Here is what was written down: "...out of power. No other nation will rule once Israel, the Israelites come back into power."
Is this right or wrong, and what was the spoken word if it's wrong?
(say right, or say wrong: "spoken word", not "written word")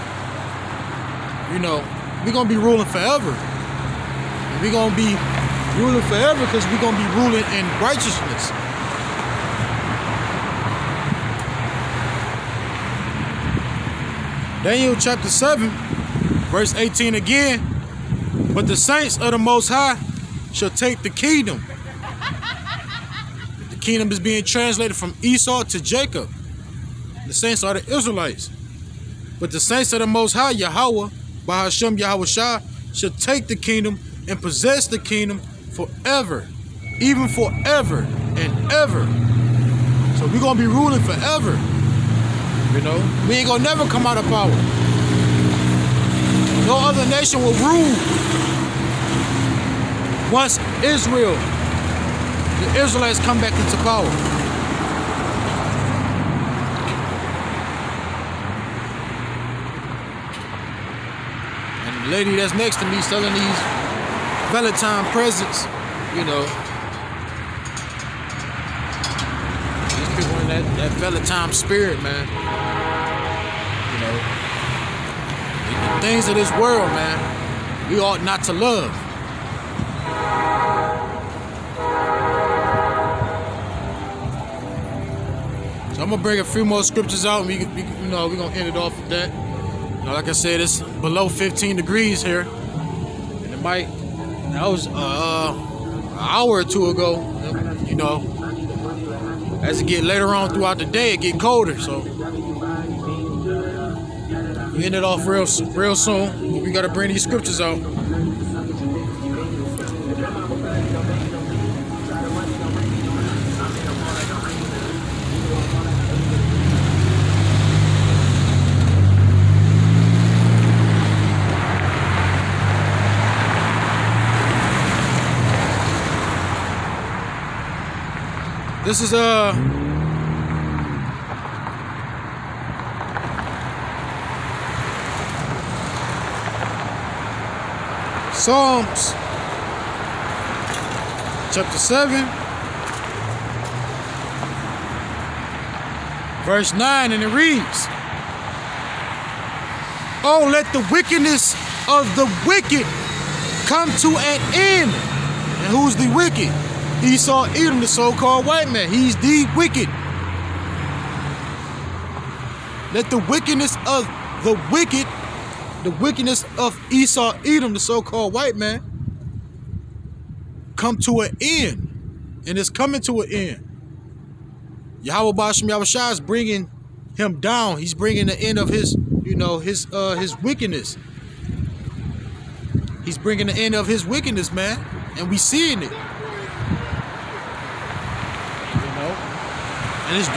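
right.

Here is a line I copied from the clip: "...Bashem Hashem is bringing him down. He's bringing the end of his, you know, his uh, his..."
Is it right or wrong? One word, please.
wrong.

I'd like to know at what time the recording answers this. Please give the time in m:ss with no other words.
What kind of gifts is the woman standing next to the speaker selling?
1:04.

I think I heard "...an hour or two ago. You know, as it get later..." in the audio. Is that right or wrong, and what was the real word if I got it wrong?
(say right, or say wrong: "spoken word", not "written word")
right.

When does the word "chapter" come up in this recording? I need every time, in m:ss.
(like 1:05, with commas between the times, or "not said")
0:14, 2:21.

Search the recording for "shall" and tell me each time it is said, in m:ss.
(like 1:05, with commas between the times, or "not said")
0:20, 0:32.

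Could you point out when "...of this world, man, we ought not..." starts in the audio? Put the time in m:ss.
1:16.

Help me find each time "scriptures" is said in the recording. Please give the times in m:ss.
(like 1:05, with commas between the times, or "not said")
1:26, 1:47.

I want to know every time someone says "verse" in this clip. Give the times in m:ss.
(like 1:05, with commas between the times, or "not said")
0:16, 2:26.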